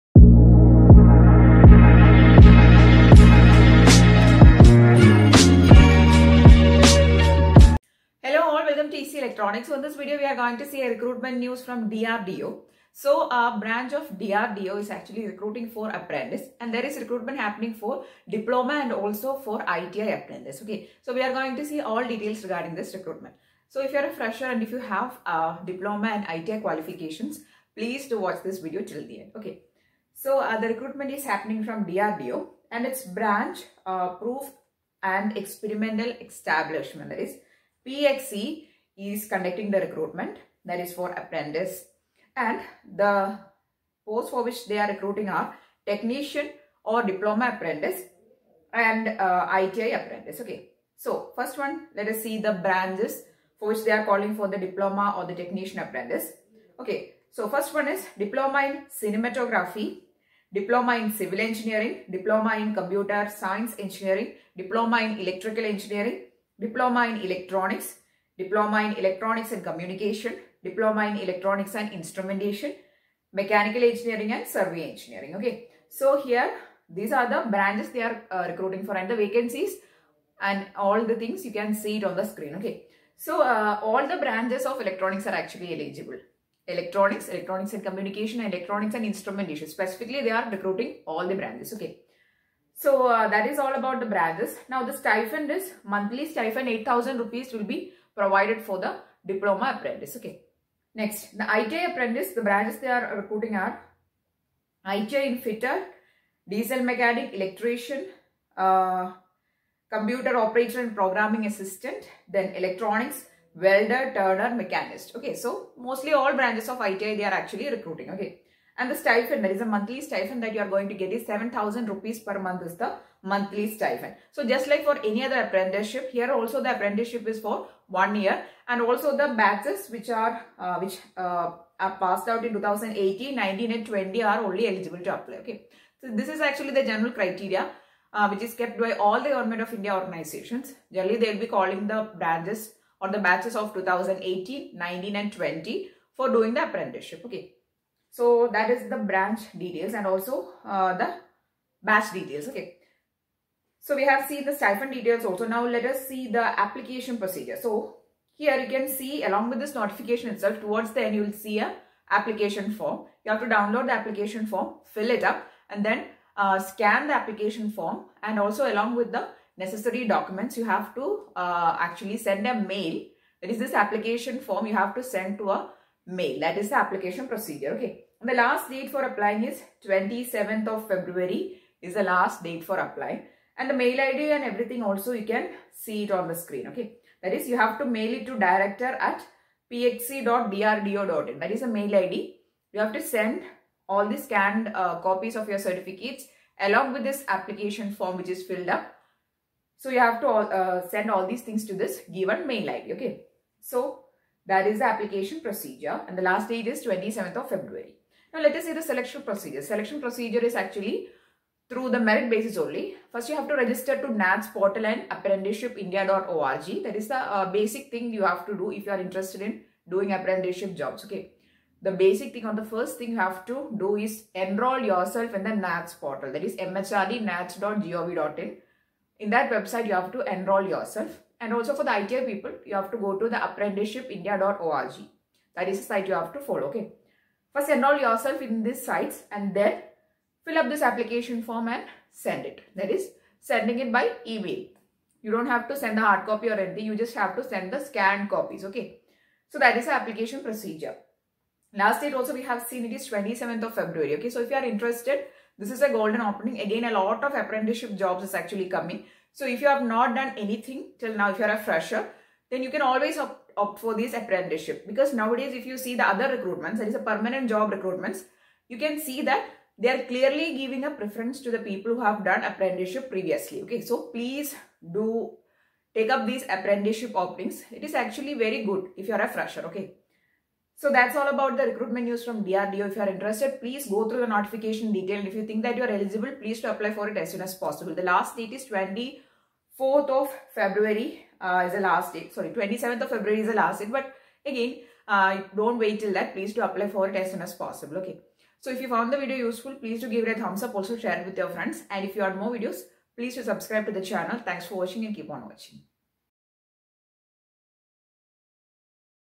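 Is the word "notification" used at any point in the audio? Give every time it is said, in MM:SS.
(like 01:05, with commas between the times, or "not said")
02:39, 04:44.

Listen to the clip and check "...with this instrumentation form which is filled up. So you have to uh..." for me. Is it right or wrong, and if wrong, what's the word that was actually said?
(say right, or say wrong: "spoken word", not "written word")
wrong: "application", not "instrumentation".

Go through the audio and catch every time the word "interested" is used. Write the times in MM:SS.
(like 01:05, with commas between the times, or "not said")
03:38, 04:14, 04:43.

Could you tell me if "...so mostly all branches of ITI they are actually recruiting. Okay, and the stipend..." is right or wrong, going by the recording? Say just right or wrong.
right.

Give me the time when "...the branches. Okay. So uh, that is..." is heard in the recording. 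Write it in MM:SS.
01:31.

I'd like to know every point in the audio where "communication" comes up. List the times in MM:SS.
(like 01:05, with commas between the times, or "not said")
01:09, 01:27.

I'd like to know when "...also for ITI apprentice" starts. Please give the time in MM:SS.
00:18.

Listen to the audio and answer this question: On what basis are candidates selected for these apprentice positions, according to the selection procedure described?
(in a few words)
Merit basis.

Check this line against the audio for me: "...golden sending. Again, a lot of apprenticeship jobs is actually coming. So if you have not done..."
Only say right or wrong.
wrong.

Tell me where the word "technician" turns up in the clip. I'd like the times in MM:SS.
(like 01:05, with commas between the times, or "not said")
00:45, 00:55.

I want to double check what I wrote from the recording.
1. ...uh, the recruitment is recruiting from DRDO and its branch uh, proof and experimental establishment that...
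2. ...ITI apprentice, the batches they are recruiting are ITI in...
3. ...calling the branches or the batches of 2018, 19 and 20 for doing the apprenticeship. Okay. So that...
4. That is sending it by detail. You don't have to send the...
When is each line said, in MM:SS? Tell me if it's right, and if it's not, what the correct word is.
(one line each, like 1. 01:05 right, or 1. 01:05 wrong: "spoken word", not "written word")
1. 00:30 wrong: "happening", not "recruiting"
2. 01:41 wrong: "branches", not "batches"
3. 02:21 right
4. 04:02 wrong: "email", not "detail".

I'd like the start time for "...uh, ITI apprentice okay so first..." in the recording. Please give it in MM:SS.
00:49.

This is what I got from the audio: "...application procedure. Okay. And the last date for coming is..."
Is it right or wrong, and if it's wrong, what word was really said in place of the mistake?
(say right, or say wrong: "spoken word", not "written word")
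wrong: "applying", not "coming".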